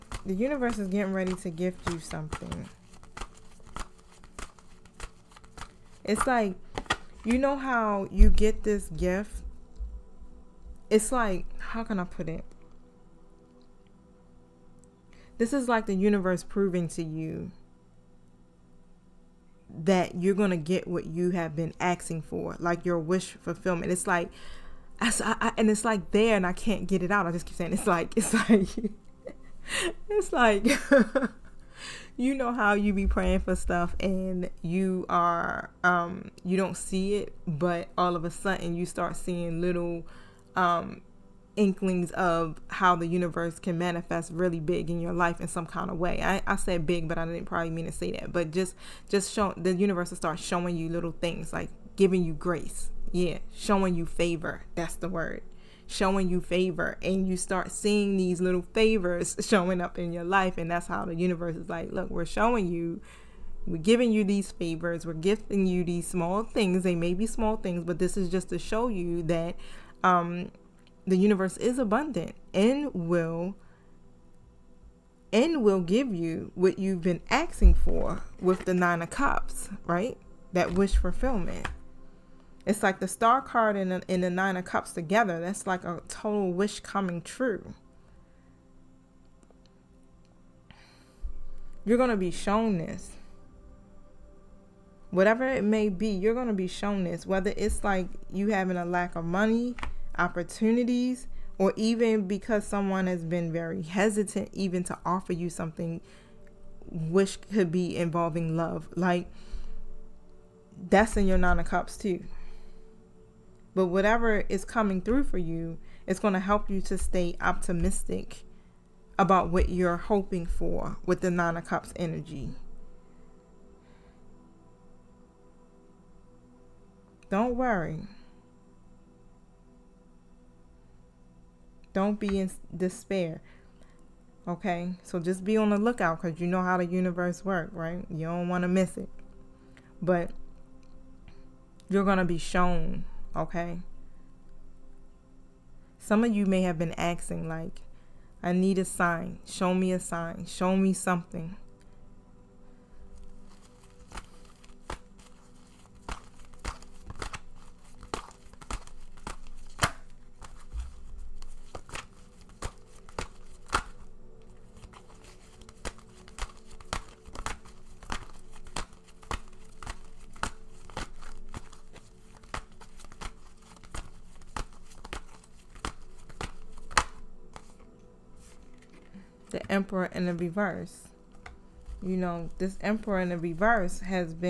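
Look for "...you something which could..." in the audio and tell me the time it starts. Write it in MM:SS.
01:45.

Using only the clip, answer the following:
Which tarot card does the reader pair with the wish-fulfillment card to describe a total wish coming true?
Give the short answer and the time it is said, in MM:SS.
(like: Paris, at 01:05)
The Star, at 01:23.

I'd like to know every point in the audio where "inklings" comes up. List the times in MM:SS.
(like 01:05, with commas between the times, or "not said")
00:41.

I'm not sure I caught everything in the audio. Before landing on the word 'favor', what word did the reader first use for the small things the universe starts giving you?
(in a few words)
grace.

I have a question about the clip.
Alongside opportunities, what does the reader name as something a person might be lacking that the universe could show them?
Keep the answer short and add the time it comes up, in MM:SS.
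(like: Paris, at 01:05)
money, at 01:39.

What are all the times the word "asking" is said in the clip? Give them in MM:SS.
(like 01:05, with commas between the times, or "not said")
00:21, 01:17, 02:26.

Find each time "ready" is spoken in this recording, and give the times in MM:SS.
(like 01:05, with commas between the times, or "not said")
00:01.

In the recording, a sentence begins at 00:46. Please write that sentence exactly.
I, I said big, but I didn't probably mean to say that.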